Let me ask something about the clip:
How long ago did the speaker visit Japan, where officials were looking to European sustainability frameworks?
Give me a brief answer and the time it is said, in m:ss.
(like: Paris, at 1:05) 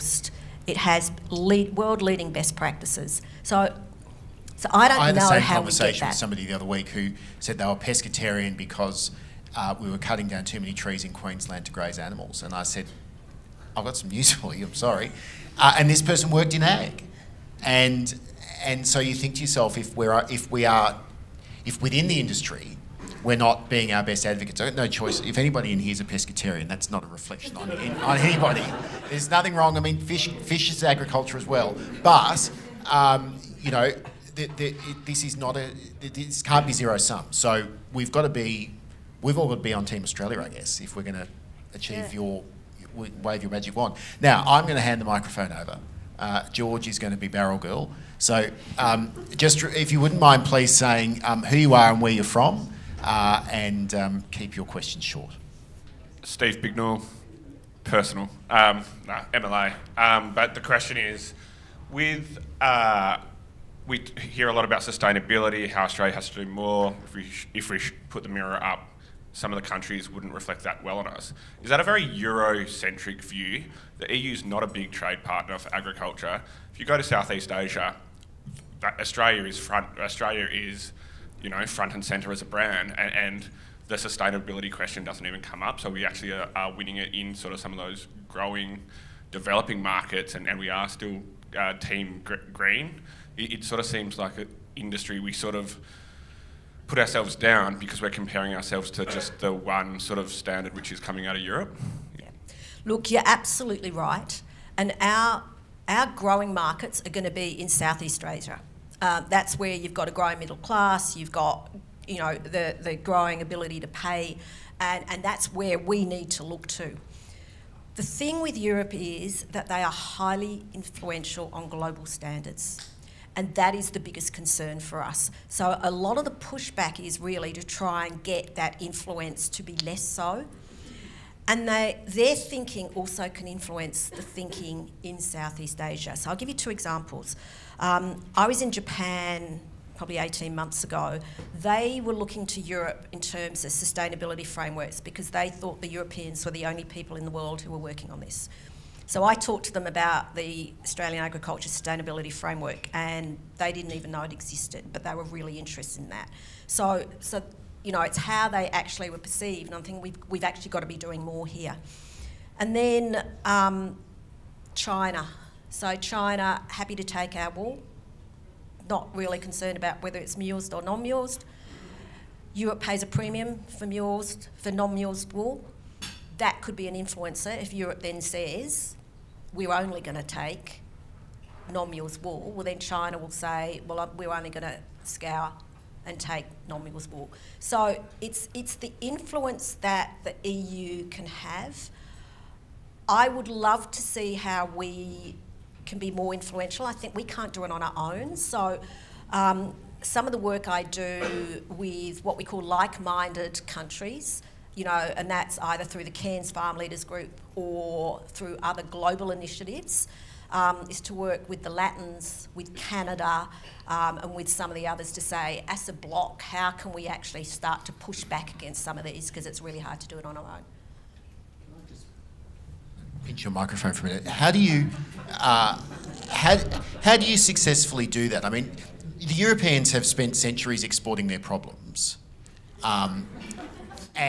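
18 months, at 2:20.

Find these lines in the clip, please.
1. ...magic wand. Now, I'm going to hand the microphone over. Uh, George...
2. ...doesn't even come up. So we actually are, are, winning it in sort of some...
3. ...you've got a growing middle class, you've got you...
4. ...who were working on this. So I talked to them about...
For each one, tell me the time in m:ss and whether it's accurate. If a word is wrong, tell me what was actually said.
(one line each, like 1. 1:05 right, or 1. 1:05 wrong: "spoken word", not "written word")
1. 0:43 right
2. 1:25 right
3. 1:49 right
4. 2:27 right.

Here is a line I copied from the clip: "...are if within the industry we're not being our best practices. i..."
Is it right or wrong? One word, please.
wrong.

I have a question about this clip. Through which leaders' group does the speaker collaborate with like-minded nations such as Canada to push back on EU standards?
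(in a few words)
Cairns Farm Leaders Group.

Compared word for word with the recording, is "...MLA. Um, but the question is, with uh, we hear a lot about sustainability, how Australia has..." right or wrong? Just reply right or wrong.
right.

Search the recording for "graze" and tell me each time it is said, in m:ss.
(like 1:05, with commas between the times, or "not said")
0:11.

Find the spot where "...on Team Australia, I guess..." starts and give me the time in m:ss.
0:39.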